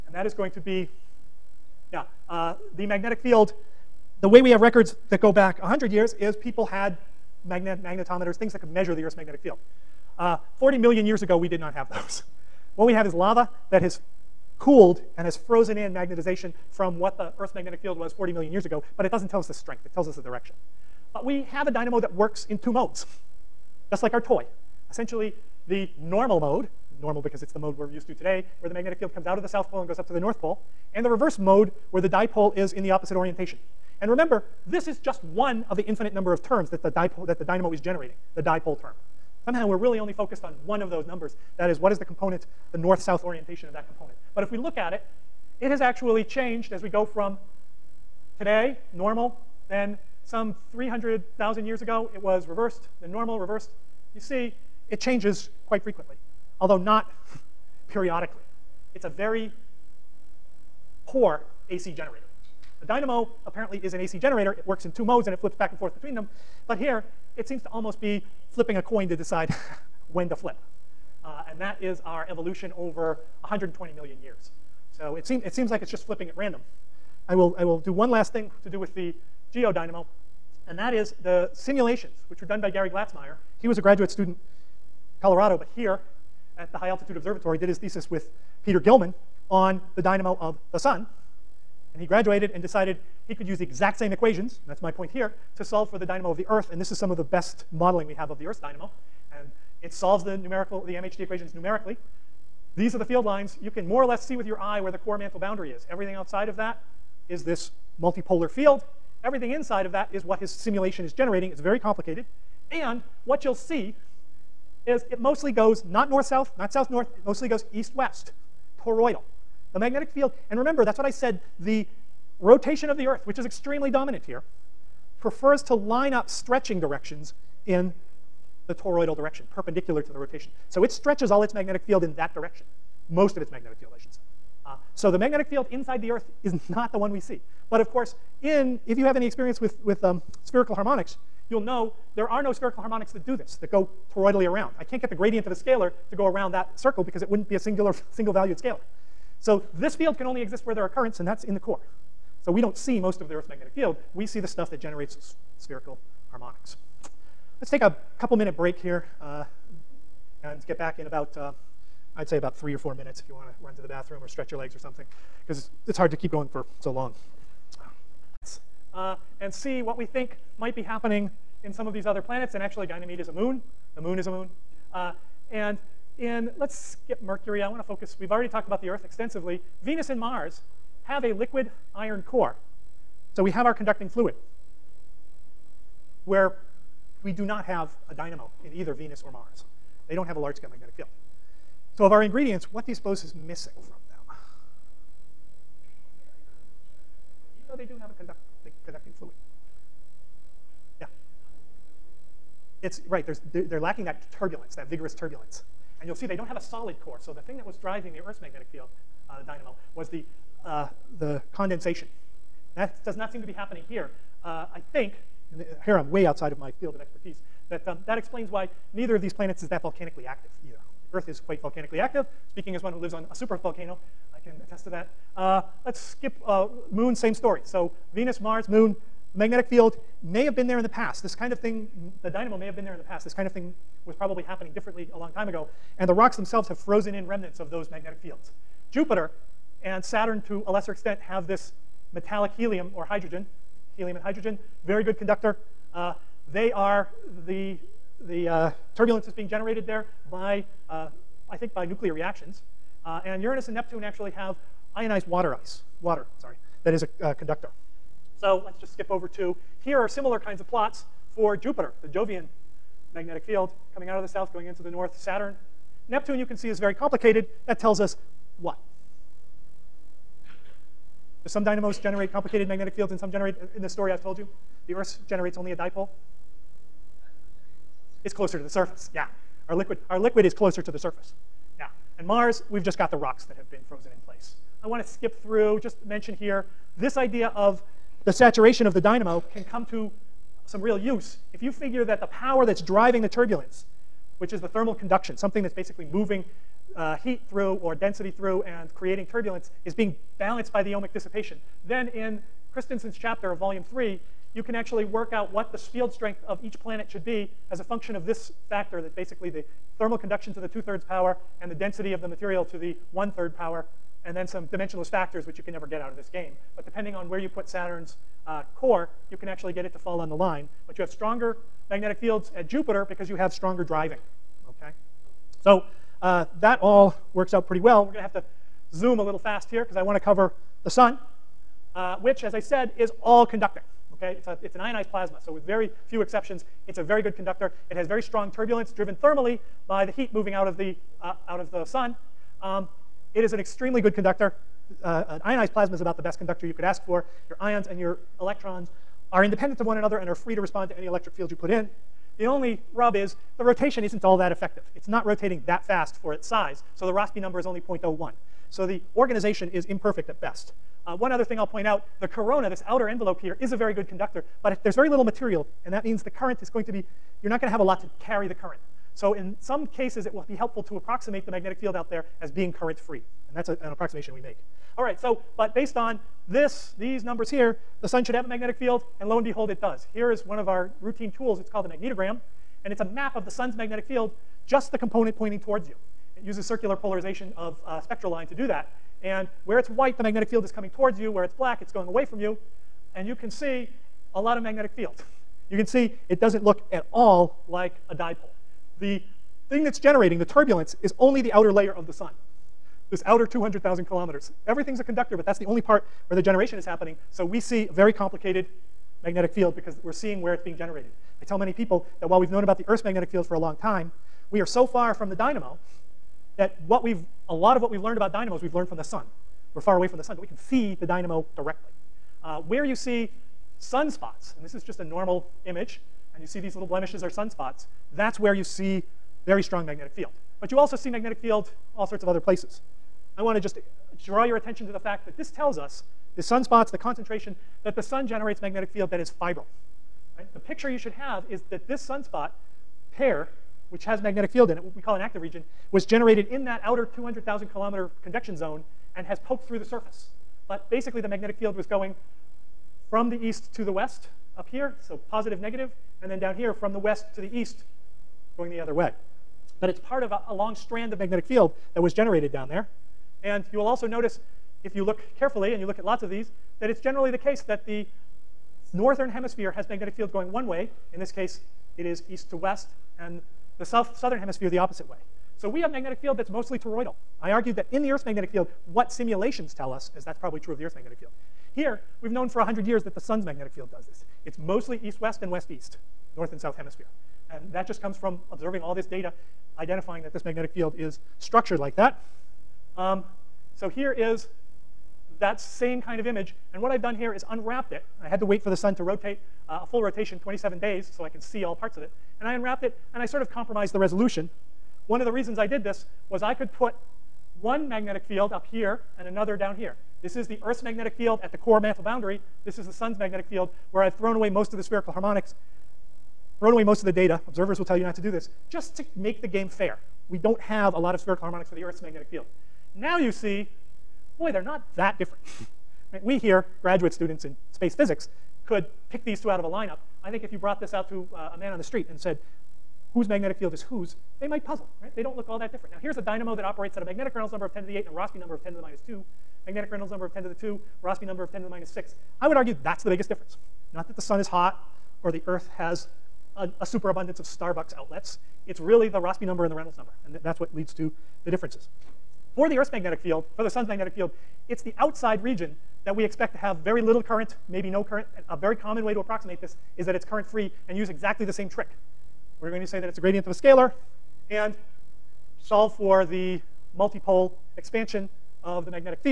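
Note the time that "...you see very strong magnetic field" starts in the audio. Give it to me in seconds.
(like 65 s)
428 s.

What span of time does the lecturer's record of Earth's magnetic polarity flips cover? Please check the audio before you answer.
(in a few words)
120 million years.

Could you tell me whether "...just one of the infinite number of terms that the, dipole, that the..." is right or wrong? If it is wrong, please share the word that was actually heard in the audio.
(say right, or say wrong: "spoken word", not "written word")
right.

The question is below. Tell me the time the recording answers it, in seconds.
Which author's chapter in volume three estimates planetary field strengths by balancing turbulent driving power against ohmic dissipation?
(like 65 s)
302 s.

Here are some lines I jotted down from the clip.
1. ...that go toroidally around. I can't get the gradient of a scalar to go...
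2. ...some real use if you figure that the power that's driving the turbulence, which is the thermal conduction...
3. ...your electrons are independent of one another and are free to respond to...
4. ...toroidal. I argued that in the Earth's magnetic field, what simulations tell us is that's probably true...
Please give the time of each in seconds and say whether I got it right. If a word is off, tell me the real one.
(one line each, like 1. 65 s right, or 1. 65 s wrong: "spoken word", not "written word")
1. 143 s right
2. 290 s right
3. 347 s right
4. 476 s right.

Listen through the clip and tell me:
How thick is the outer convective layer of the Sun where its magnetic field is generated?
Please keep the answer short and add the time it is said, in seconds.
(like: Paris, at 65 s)
200,000 kilometers, at 403 s.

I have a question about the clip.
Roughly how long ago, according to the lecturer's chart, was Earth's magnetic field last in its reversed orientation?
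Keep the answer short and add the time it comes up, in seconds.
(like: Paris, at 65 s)
300,000 years ago, at 50 s.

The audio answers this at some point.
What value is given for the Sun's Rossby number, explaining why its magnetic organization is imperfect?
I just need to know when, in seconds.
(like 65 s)
357 s.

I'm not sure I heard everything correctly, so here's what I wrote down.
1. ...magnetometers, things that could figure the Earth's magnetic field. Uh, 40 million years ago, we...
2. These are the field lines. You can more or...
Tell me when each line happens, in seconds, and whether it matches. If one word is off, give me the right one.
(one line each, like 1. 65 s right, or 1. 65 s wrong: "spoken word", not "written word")
1. 7 s wrong: "measure", not "figure"
2. 102 s right.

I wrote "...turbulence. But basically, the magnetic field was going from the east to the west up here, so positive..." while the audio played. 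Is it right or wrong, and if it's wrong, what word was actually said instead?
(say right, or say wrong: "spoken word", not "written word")
wrong: "surface", not "turbulence".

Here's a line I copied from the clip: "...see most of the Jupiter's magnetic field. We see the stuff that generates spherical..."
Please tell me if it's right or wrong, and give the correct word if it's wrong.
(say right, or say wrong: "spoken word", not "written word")
wrong: "Earth", not "Jupiter".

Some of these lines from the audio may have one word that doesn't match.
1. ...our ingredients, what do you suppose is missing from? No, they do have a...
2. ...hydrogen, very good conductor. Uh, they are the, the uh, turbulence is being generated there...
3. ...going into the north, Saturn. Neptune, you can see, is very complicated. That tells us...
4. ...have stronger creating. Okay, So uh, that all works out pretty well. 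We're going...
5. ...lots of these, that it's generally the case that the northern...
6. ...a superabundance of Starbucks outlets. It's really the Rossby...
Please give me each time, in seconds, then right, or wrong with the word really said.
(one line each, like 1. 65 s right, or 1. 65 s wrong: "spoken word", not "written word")
1. 192 s right
2. 244 s right
3. 264 s right
4. 323 s wrong: "driving", not "creating"
5. 466 s right
6. 546 s right.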